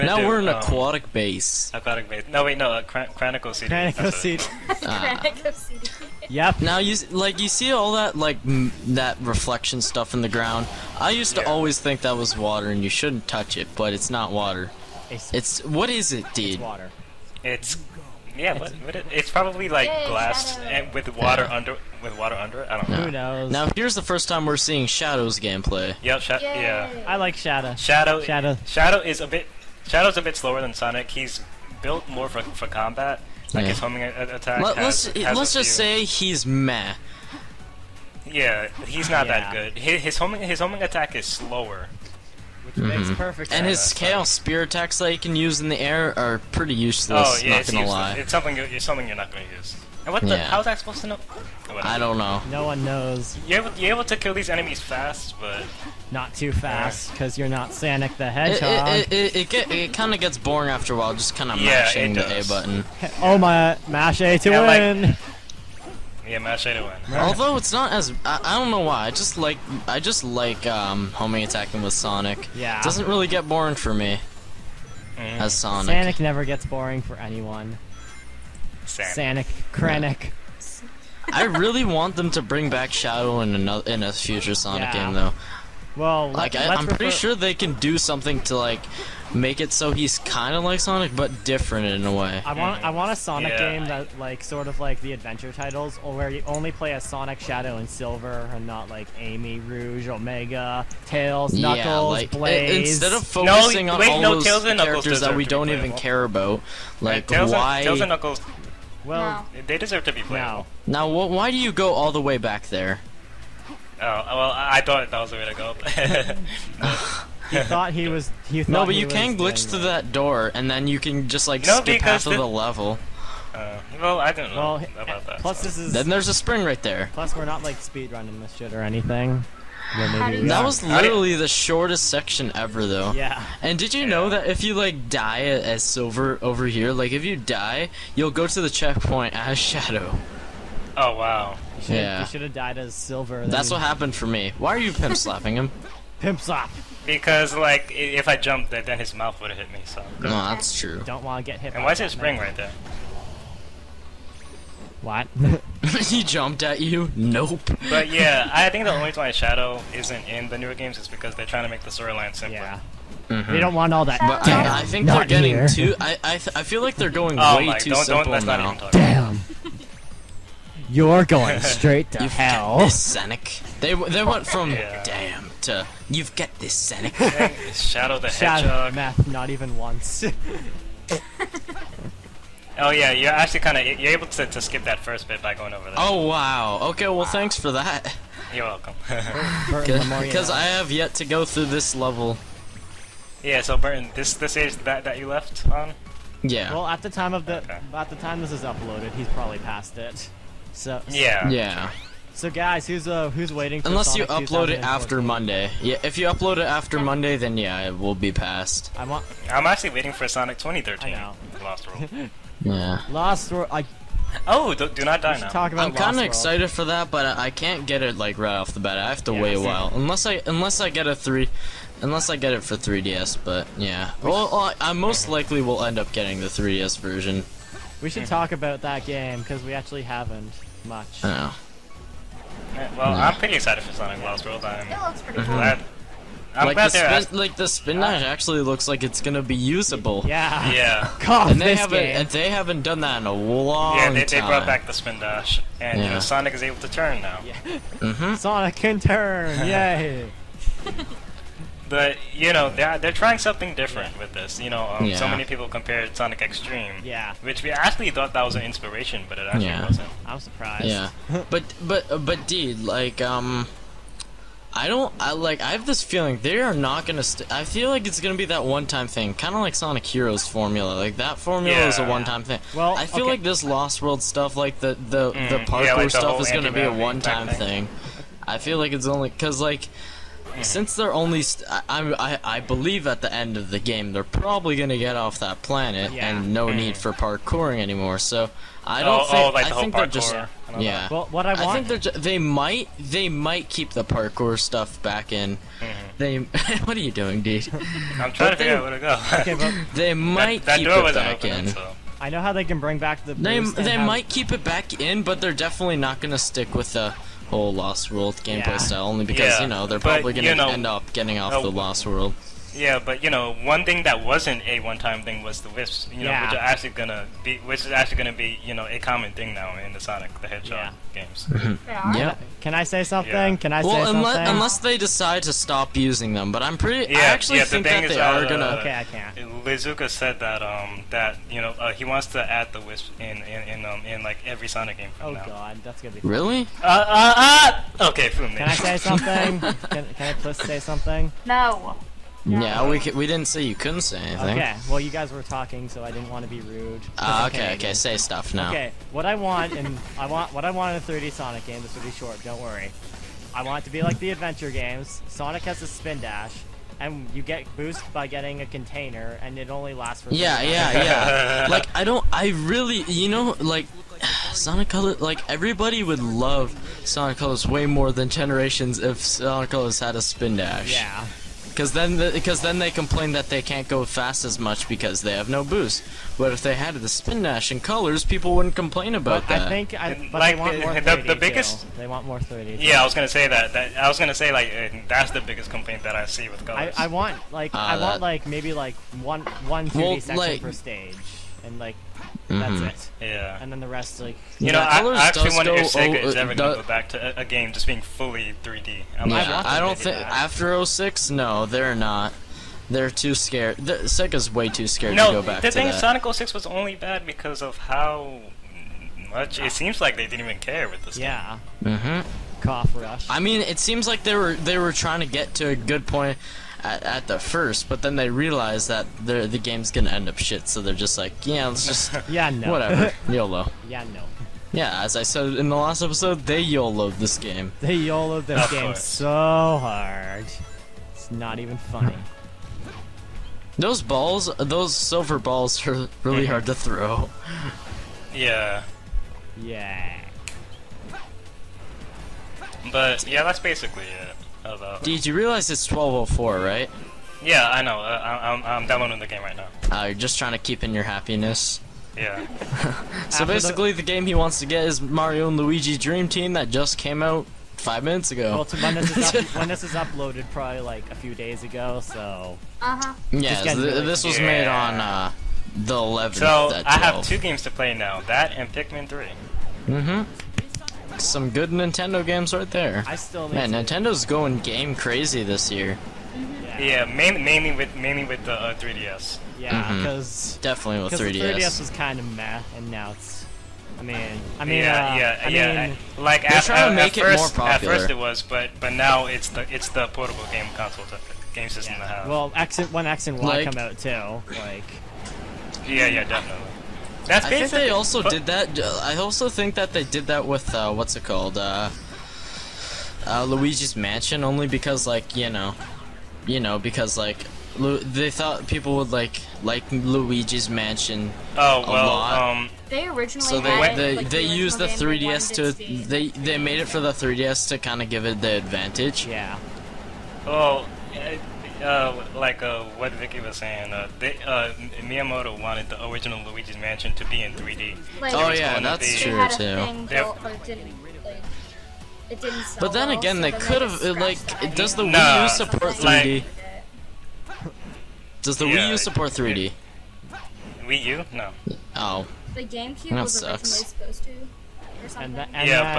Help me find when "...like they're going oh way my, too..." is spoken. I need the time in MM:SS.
02:46.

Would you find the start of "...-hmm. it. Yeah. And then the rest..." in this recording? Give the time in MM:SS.
06:32.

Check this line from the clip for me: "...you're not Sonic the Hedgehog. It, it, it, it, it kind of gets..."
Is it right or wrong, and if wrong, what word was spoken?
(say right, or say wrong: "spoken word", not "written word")
right.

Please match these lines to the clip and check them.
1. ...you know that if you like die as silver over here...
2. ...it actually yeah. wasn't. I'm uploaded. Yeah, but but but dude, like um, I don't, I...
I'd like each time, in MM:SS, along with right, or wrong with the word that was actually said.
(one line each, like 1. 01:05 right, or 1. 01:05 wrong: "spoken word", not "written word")
1. 02:13 right
2. 04:19 wrong: "surprised", not "uploaded".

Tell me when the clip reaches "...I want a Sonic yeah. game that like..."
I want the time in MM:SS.
01:32.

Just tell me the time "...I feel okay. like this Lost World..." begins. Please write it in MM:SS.
04:32.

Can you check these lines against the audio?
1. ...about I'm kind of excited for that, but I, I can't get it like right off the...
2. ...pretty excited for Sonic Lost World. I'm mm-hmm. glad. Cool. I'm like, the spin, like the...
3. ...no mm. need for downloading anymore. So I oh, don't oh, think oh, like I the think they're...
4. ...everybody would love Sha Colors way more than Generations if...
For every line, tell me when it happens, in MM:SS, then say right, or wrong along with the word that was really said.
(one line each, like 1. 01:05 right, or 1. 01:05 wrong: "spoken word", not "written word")
1. 03:35 right
2. 03:53 right
3. 04:46 wrong: "parkouring", not "downloading"
4. 06:05 wrong: "Sonic", not "Sha".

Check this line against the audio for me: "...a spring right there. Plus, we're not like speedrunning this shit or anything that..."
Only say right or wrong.
right.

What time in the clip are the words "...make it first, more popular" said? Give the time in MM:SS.
08:07.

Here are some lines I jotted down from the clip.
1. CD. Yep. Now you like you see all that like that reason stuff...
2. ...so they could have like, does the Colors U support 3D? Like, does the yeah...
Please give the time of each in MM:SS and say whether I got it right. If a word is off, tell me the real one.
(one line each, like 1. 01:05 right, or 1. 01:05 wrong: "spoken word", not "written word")
1. 00:05 wrong: "reflection", not "reason"
2. 08:53 wrong: "Wii", not "Colors".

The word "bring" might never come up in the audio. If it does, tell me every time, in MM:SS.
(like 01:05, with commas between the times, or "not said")
01:22, 05:02.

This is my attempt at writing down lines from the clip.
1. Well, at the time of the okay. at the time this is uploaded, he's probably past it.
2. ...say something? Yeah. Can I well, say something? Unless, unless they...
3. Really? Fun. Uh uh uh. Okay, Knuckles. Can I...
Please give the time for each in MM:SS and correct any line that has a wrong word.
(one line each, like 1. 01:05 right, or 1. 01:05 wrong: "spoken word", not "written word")
1. 03:16 right
2. 05:22 right
3. 05:36 wrong: "Fumi", not "Knuckles".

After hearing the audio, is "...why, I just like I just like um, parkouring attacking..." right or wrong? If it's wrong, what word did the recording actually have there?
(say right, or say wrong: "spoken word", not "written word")
wrong: "homing", not "parkouring".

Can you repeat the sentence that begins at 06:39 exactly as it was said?
I'm yeah, I, don't think after 06, no, they're not.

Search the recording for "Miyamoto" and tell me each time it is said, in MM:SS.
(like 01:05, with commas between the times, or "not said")
08:44.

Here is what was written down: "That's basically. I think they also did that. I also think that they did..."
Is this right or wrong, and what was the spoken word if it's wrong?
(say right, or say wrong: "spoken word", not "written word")
right.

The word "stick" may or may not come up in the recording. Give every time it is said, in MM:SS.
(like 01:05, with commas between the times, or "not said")
05:06.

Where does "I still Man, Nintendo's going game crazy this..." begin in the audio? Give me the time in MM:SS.
07:53.